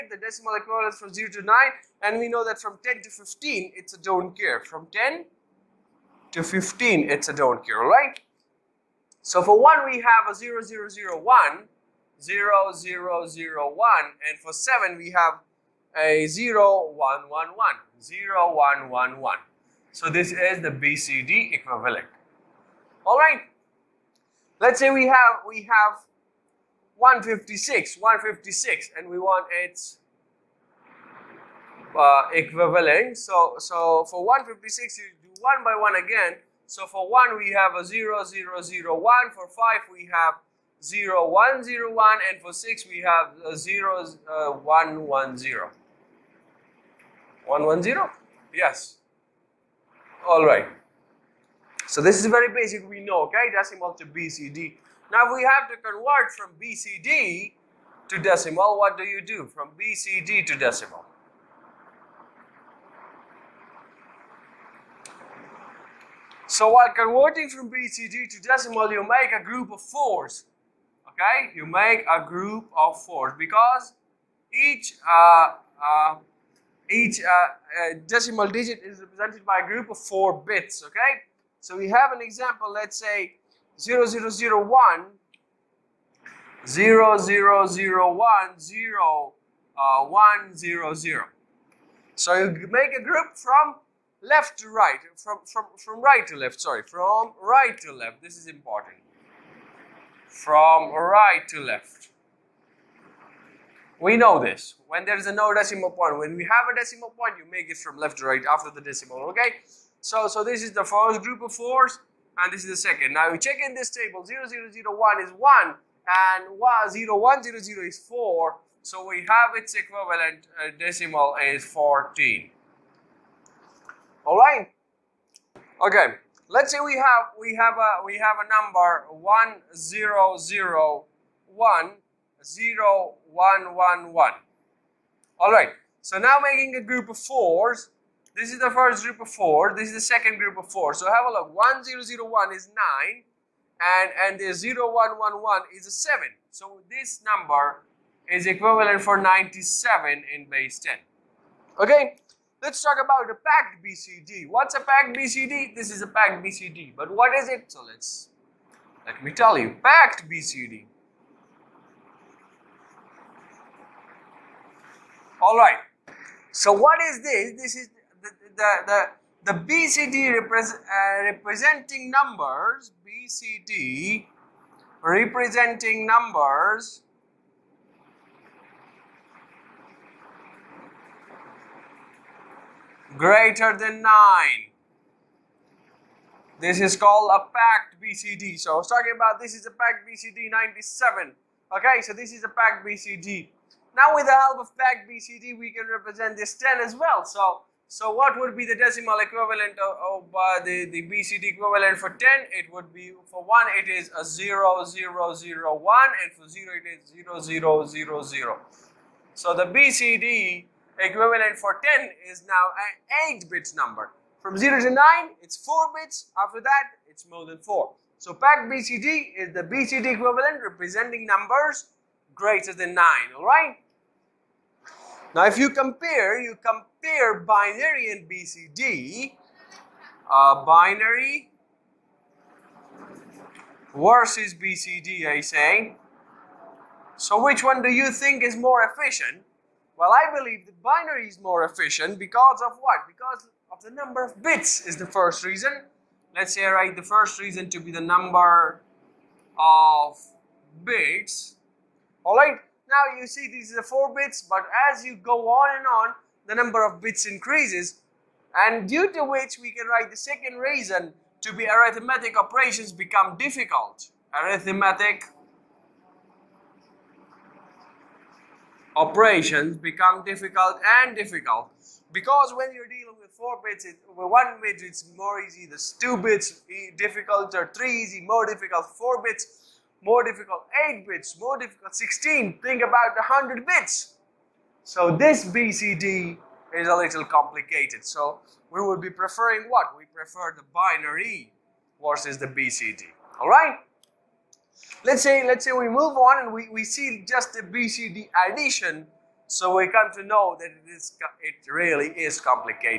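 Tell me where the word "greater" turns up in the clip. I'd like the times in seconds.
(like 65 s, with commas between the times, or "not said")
183 s, 222 s.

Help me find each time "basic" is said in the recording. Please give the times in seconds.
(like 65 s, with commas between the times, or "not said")
52 s.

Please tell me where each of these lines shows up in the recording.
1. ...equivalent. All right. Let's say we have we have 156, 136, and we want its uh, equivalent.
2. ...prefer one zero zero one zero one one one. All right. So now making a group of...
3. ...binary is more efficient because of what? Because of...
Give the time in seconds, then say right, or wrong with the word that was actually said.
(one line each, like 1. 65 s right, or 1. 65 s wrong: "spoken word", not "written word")
1. 21 s wrong: "156", not "136"
2. 128 s wrong: "number", not "prefer"
3. 240 s right.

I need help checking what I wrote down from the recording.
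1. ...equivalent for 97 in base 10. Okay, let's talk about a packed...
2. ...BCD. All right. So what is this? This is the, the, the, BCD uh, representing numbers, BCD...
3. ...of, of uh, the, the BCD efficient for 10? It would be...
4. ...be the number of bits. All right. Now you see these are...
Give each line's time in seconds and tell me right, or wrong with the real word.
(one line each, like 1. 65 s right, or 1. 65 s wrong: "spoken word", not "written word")
1. 148 s right
2. 160 s right
3. 199 s wrong: "equivalent", not "efficient"
4. 247 s right.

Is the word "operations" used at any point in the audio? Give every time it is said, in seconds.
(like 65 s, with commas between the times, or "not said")
262 s, 268 s.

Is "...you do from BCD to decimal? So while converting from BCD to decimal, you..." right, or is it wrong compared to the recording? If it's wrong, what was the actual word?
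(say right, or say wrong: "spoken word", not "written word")
right.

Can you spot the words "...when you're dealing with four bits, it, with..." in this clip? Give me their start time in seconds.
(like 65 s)
272 s.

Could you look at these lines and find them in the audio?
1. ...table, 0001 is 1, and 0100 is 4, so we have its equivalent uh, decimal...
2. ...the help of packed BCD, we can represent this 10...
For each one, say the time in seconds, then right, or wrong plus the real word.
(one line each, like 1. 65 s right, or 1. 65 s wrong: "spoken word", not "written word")
1. 113 s right
2. 194 s right.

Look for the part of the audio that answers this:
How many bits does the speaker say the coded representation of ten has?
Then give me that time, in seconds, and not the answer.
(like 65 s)
213 s.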